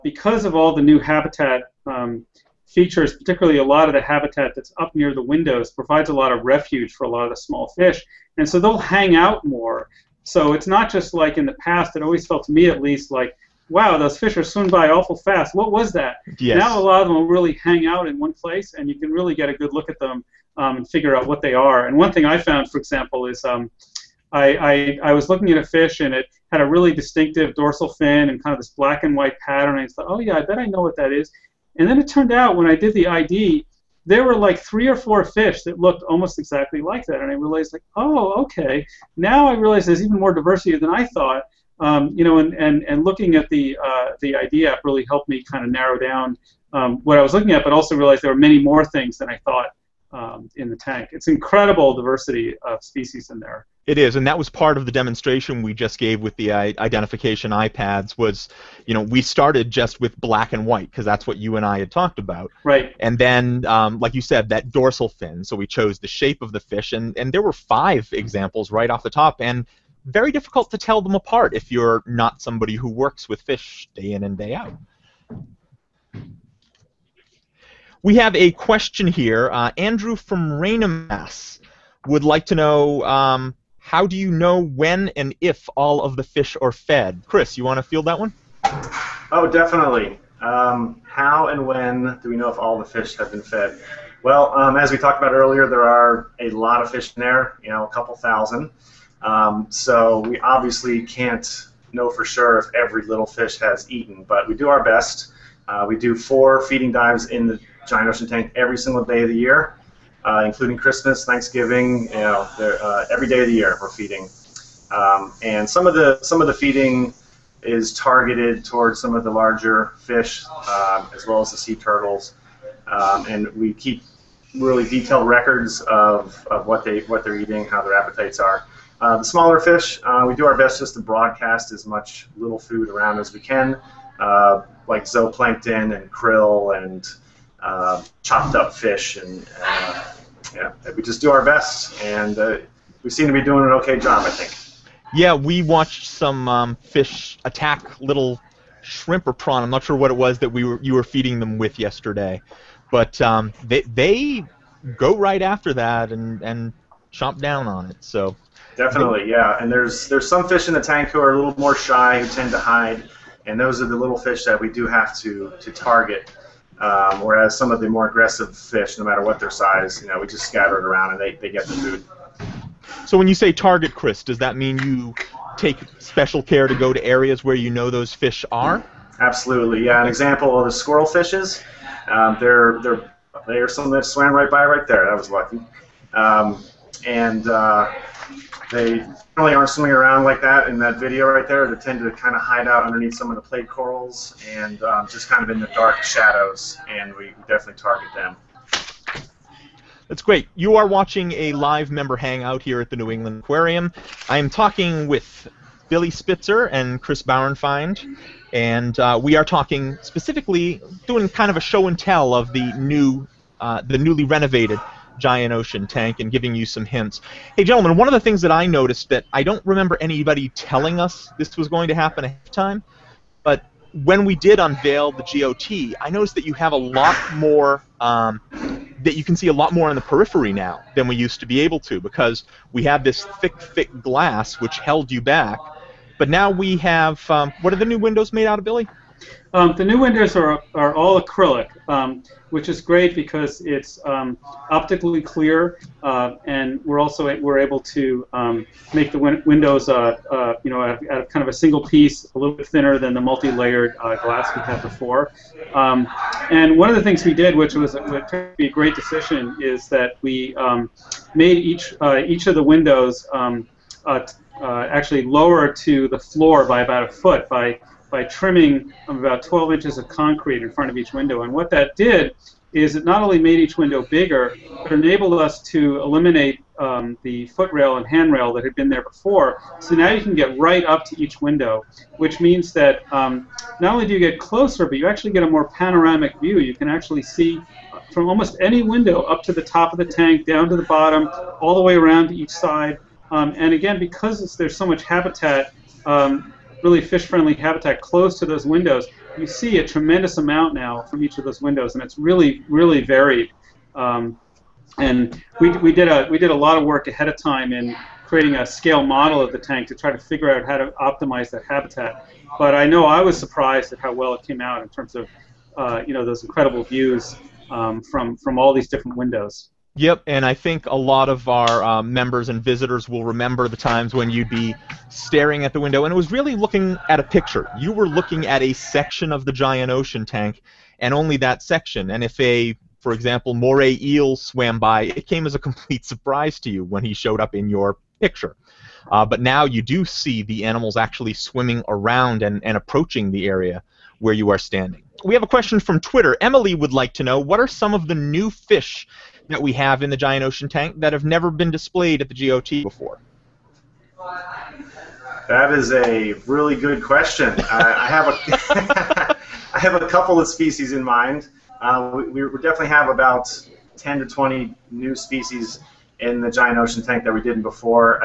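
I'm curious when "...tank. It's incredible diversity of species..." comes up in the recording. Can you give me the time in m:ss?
0:50.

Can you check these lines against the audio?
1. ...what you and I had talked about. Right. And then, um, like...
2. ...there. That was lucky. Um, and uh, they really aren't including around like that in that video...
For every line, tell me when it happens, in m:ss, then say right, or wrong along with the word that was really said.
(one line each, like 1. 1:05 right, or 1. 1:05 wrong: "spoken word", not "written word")
1. 1:01 right
2. 3:04 wrong: "swimming", not "including".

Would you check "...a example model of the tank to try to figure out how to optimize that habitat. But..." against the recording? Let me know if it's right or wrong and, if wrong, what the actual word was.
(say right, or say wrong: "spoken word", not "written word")
wrong: "scale", not "example".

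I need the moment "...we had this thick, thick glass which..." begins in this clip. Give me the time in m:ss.
3:52.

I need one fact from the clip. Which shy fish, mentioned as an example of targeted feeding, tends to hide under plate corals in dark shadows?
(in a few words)
squirrel fishes.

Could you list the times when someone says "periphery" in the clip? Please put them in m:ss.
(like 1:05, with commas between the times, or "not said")
3:50.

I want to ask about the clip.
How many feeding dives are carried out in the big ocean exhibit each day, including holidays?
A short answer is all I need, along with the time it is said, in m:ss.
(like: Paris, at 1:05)
4, at 1:46.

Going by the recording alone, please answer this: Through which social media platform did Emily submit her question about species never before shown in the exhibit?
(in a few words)
Twitter.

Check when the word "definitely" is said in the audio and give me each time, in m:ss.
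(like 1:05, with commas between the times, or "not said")
1:29, 2:38, 3:17, 6:02.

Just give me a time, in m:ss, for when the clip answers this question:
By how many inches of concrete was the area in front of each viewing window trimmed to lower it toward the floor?
4:29.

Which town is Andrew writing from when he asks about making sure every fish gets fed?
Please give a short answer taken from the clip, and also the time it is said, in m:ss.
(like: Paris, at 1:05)
Raynham, Mass, at 1:20.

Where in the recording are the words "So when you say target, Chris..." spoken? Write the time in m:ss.
2:53.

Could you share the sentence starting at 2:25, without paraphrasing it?
Yeah, we watched some um, fish attack little shrimp or prawn.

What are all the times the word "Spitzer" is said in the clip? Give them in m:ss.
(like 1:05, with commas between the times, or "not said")
3:26.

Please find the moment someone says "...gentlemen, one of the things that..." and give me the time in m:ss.
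3:37.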